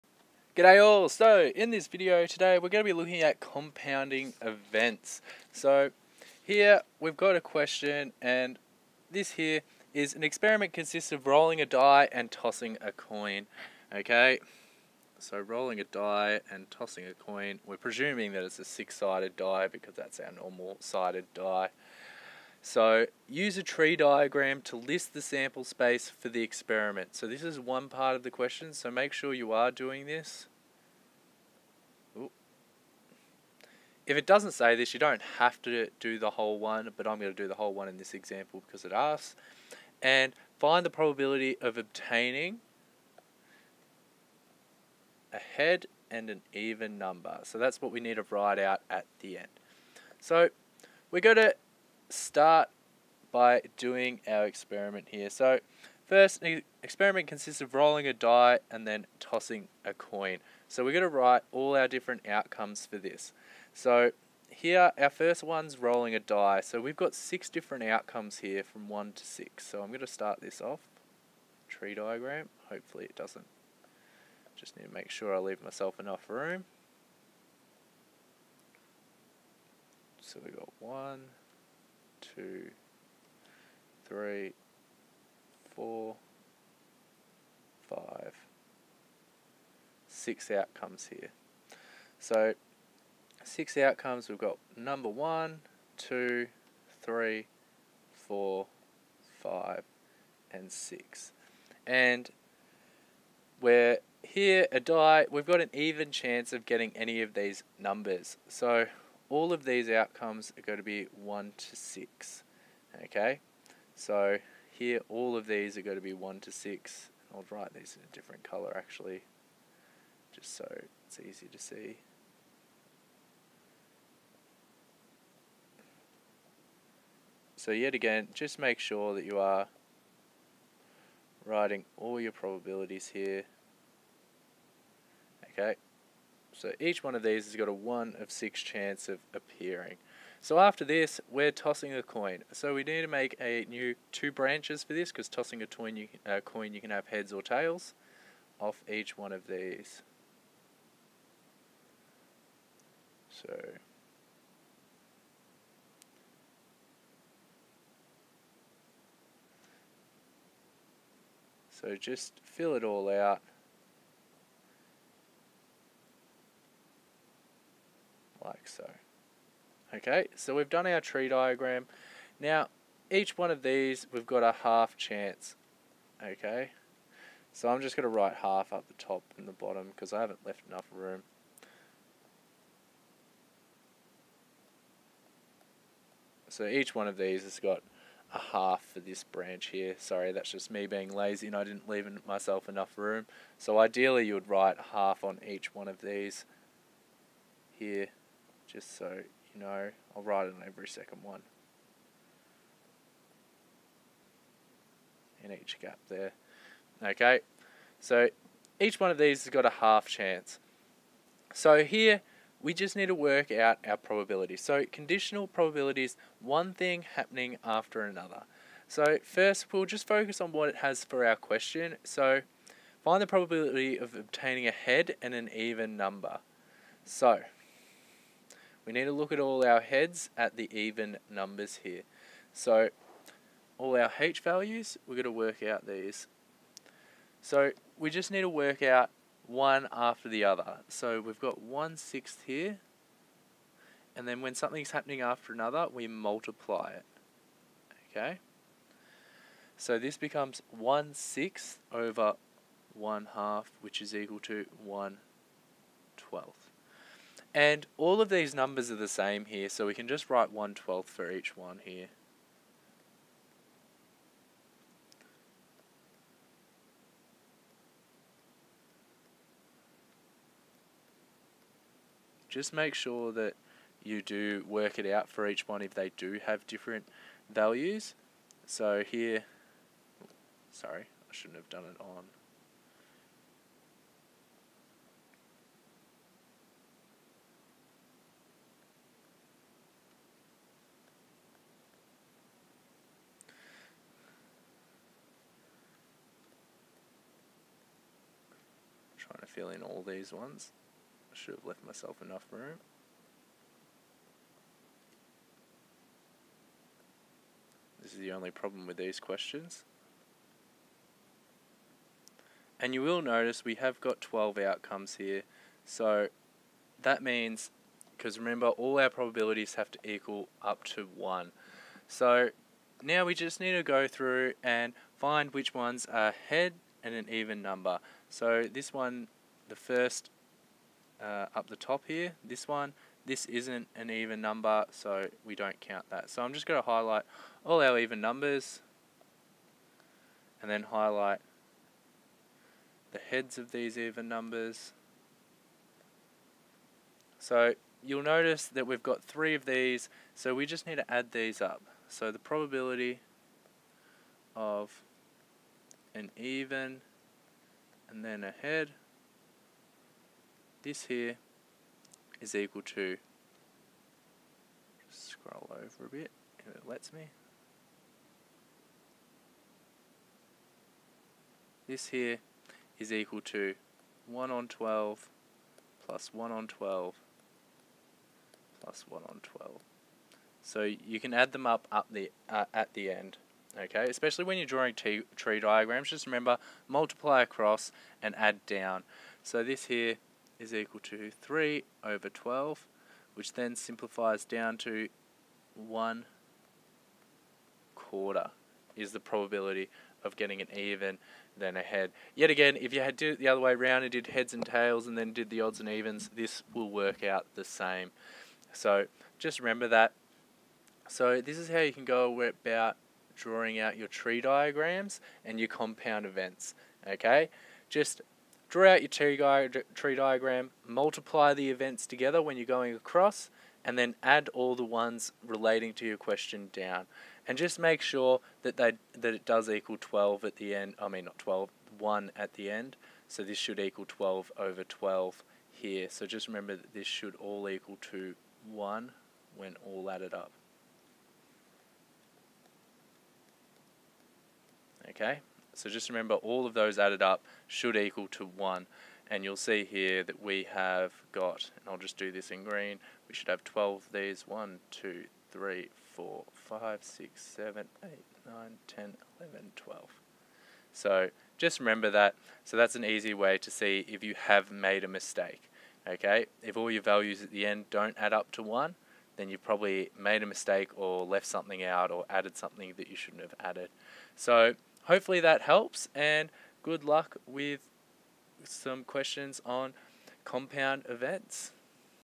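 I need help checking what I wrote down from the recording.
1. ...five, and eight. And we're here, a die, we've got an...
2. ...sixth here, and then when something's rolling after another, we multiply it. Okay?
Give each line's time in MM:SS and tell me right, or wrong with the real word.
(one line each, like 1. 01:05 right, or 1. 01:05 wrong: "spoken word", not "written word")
1. 01:39 wrong: "six", not "eight"
2. 04:01 wrong: "happening", not "rolling".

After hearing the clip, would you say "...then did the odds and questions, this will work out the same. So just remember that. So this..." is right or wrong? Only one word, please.
wrong.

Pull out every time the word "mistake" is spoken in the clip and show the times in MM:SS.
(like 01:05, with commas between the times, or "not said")
07:45, 07:50.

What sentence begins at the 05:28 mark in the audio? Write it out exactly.
So this one, the first uh, up the top here, this one, this isn't an even number, so we don't count that.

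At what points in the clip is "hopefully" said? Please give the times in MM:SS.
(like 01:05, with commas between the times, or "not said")
01:12, 07:55.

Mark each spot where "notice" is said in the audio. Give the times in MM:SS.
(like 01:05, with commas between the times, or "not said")
05:13, 05:48.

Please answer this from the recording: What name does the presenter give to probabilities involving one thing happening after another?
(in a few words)
conditional probabilities.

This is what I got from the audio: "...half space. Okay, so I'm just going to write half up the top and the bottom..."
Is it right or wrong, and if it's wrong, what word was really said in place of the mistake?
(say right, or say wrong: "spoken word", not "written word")
wrong: "chance", not "space".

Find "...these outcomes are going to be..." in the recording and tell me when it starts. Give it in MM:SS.
01:49.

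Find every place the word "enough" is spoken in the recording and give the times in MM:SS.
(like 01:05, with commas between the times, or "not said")
01:15, 03:00, 03:12, 05:02.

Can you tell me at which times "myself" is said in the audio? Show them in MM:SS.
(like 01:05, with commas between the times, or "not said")
01:15, 03:12, 05:01.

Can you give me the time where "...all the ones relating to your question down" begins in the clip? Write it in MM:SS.
07:04.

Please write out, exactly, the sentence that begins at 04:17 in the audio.
And all of these numbers are the same here, so we can just write 1 12th for each one here.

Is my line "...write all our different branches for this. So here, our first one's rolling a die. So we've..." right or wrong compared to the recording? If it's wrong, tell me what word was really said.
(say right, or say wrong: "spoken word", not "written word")
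wrong: "outcomes", not "branches".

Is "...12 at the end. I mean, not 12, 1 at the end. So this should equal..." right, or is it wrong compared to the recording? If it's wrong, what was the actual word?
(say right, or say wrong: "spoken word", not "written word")
right.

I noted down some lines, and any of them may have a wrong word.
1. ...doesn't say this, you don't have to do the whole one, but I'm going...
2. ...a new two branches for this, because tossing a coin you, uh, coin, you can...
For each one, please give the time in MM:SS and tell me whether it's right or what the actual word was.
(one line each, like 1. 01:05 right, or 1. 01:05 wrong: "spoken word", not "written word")
1. 00:34 right
2. 02:23 right.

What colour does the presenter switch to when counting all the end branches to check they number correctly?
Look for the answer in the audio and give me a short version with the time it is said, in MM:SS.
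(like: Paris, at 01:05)
green, at 07:32.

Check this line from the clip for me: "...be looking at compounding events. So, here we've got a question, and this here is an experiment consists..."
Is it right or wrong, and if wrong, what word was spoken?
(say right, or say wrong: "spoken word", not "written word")
right.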